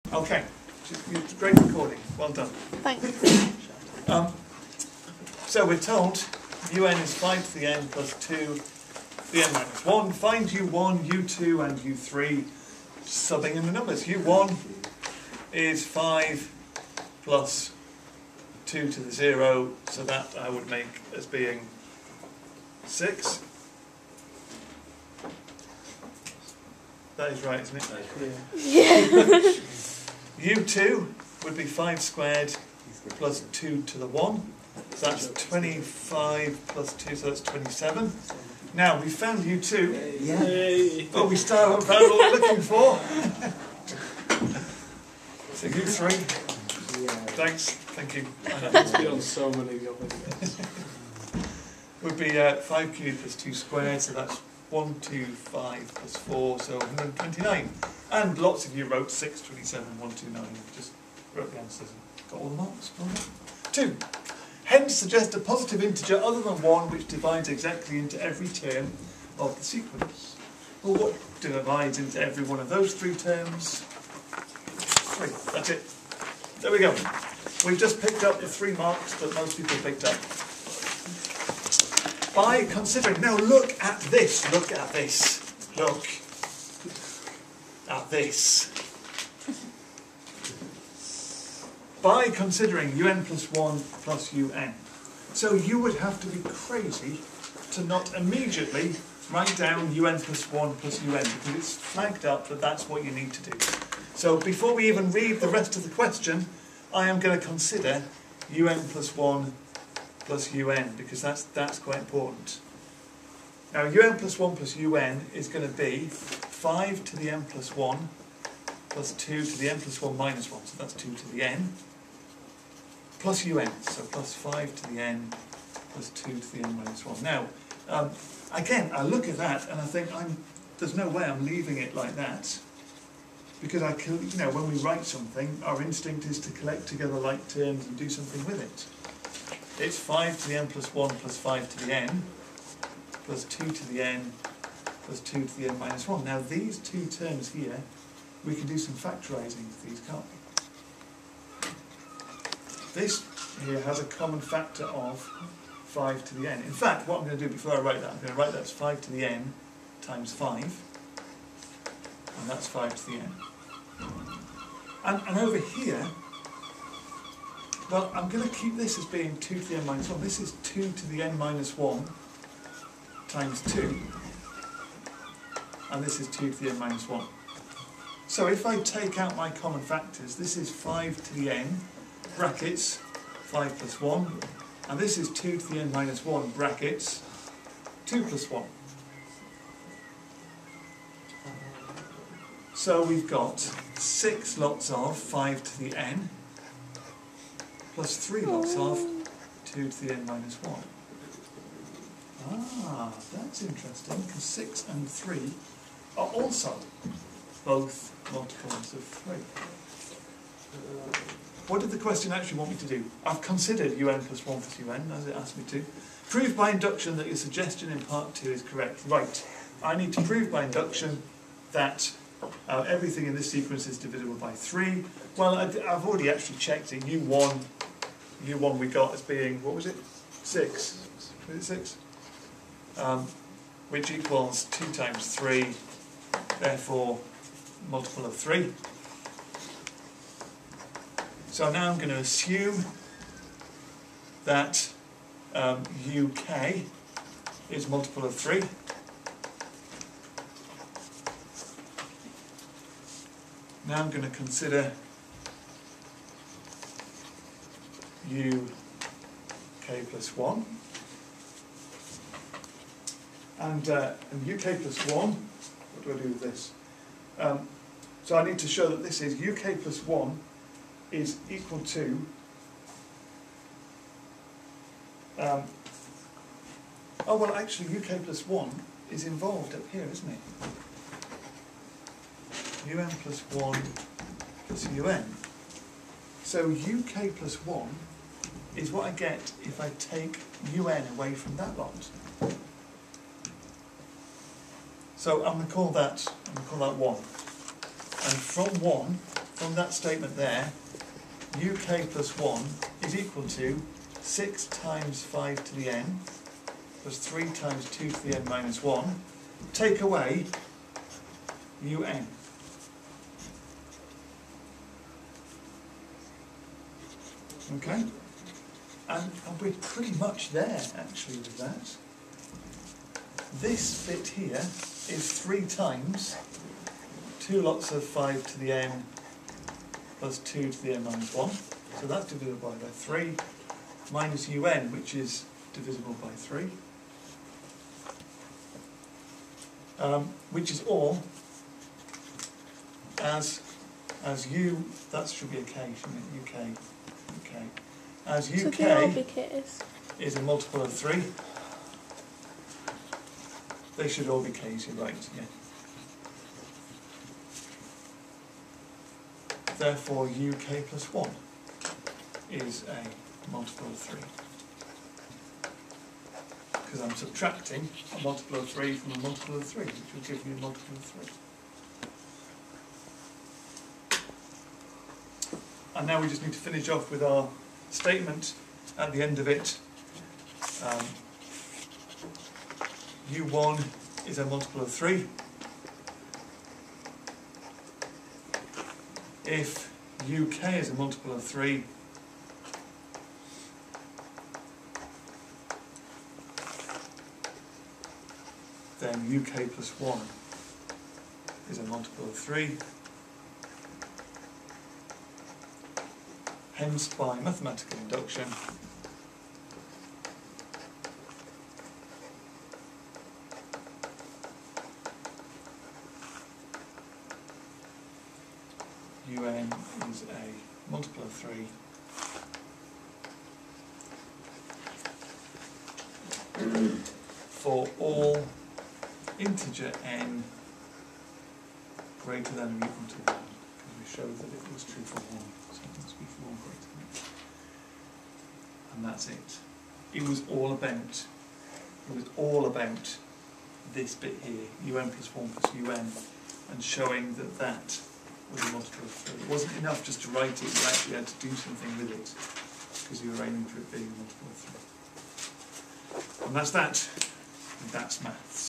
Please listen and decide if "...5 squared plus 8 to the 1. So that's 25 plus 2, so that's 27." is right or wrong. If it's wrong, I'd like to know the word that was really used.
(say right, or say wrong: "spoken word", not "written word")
wrong: "2", not "8".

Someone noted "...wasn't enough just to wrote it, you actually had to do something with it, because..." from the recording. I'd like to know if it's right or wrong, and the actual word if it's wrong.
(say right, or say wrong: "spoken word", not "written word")
wrong: "write", not "wrote".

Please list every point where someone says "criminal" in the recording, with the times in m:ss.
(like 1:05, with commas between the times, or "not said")
not said.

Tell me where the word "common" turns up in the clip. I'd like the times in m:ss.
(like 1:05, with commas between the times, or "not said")
2:34, 2:59.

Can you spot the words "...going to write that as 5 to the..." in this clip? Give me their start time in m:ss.
2:38.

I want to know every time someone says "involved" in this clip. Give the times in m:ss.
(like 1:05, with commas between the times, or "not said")
4:39.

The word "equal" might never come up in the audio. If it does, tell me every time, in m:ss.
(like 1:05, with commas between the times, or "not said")
3:54, 4:31, 5:03, 7:12.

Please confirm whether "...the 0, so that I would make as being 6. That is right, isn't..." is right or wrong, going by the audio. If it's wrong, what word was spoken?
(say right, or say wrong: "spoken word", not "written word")
right.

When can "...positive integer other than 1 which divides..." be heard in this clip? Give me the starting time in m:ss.
1:05.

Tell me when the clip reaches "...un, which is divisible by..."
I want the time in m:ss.
5:34.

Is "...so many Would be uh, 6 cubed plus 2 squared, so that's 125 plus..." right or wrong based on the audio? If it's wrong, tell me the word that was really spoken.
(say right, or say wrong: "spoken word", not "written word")
wrong: "5", not "6".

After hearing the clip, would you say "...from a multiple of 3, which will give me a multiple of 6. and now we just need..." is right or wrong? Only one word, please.
wrong.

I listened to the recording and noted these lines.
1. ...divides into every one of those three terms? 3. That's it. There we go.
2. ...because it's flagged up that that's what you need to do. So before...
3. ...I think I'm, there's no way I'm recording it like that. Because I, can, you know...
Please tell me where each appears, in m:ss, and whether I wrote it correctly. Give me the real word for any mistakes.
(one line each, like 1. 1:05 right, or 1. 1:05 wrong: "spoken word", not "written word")
1. 1:11 right
2. 1:41 right
3. 2:09 wrong: "leaving", not "recording".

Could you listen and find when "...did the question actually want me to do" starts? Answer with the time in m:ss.
3:31.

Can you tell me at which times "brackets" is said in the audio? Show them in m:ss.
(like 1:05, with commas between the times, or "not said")
3:02, 3:06.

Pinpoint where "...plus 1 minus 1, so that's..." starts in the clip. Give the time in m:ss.
1:59.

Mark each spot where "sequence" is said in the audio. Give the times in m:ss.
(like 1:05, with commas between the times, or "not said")
1:09, 3:43.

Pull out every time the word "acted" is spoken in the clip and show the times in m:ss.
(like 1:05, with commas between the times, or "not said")
not said.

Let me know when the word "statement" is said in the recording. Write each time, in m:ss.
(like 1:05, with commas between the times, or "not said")
4:59, 6:17.